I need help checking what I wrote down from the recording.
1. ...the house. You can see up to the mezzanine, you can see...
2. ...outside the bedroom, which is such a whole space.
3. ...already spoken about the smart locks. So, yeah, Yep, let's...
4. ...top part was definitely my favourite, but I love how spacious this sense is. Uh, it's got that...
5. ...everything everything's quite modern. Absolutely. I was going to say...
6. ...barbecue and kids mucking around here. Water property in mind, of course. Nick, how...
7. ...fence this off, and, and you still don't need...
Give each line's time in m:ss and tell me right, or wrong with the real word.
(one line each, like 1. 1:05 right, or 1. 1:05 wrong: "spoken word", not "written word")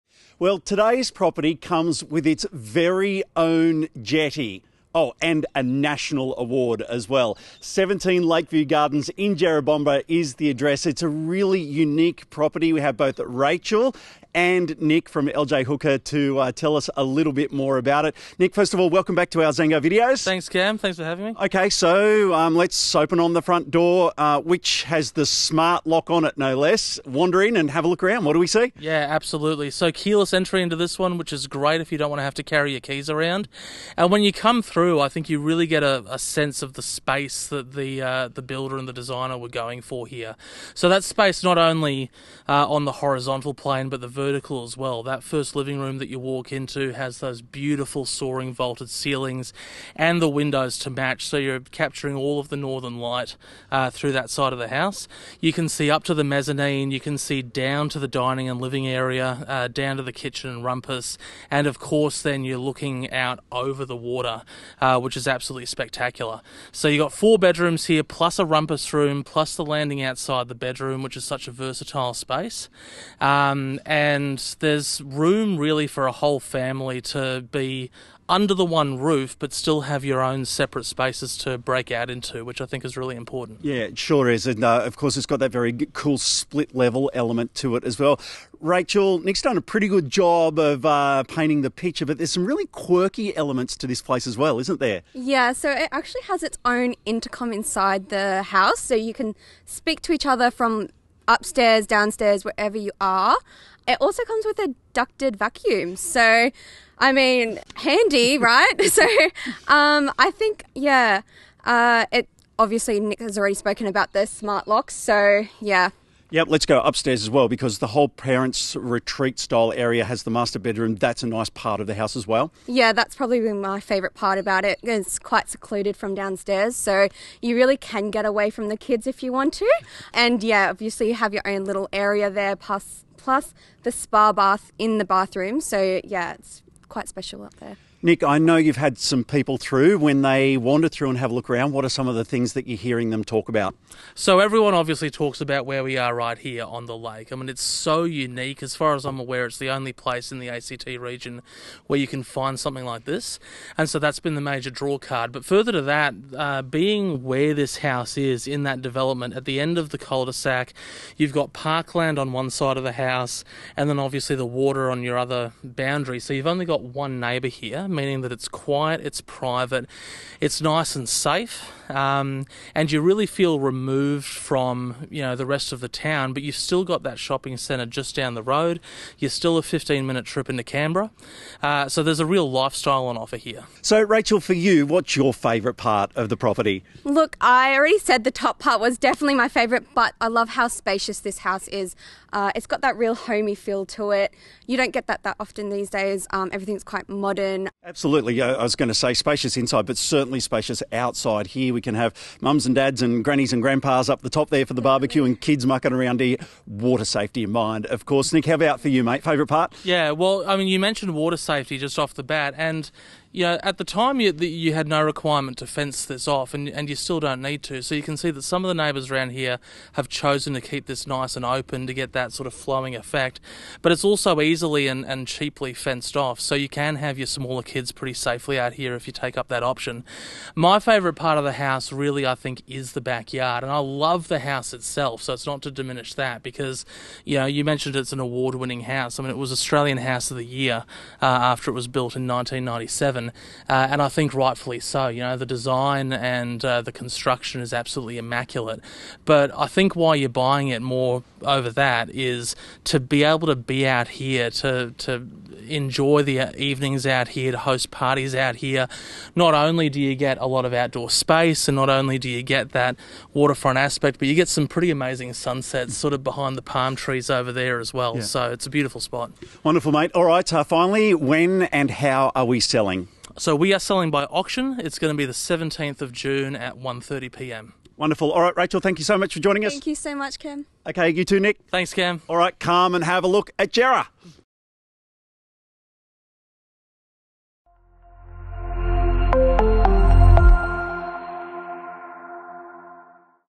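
1. 0:54 right
2. 1:10 wrong: "versatile", not "whole"
3. 1:53 right
4. 3:08 wrong: "house", not "sense"
5. 3:16 right
6. 3:24 wrong: "safety", not "property"
7. 3:35 right.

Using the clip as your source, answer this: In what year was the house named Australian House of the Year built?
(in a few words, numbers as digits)
1997.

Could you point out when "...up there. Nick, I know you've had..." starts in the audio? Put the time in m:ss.
2:17.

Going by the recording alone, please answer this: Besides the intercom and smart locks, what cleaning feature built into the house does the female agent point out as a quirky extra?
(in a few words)
Ducted vacuum.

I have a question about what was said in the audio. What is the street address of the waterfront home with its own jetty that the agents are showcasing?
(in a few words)
17 Lakeview Gardens.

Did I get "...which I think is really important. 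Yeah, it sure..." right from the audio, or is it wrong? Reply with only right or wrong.
right.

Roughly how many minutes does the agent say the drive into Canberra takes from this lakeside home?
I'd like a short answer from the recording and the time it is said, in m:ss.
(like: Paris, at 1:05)
15 minutes, at 2:59.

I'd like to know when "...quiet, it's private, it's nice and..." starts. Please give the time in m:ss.
2:48.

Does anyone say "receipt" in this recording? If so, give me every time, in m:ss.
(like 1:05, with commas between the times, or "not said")
not said.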